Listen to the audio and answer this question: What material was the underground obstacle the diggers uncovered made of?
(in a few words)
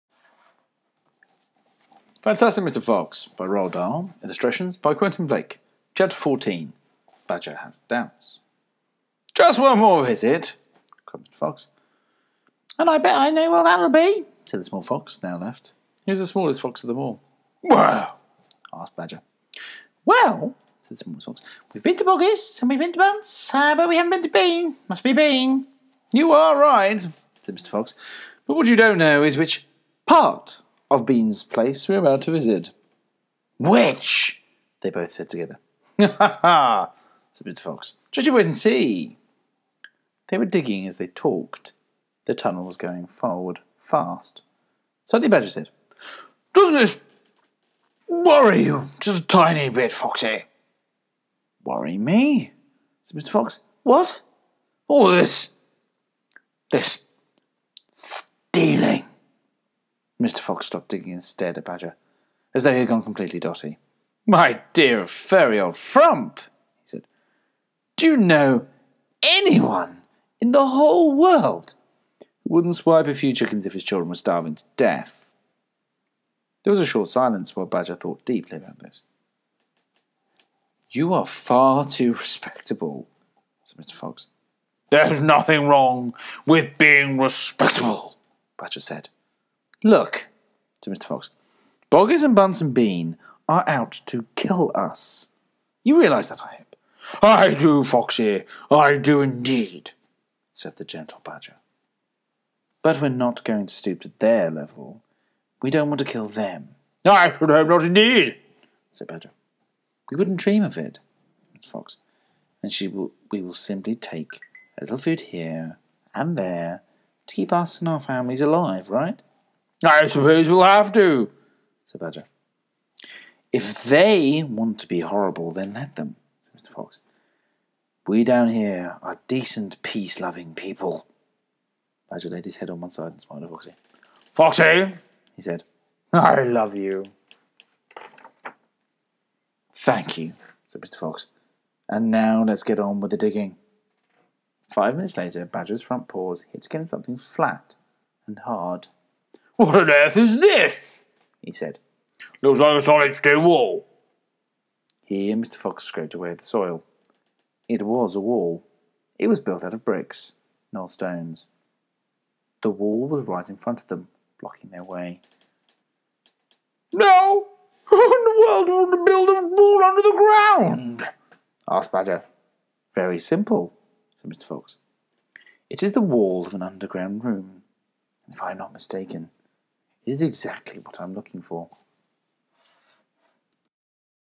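Bricks.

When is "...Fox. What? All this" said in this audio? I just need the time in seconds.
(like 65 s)
53 s.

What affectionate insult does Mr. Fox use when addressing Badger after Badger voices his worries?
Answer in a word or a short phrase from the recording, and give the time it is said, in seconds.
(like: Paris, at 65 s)
My dear furry old frump, at 64 s.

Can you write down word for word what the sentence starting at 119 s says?
I suppose we'll have to, said Badger.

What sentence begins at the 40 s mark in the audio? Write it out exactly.
They were digging as they talked.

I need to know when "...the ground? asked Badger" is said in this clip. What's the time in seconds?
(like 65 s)
170 s.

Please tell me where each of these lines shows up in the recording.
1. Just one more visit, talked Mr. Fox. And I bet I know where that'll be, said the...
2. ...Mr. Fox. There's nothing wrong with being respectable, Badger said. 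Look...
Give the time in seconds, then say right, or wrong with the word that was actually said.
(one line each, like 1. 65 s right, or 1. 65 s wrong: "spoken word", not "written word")
1. 9 s wrong: "cried", not "talked"
2. 83 s right.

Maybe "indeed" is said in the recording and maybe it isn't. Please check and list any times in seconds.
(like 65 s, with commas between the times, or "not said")
99 s, 107 s.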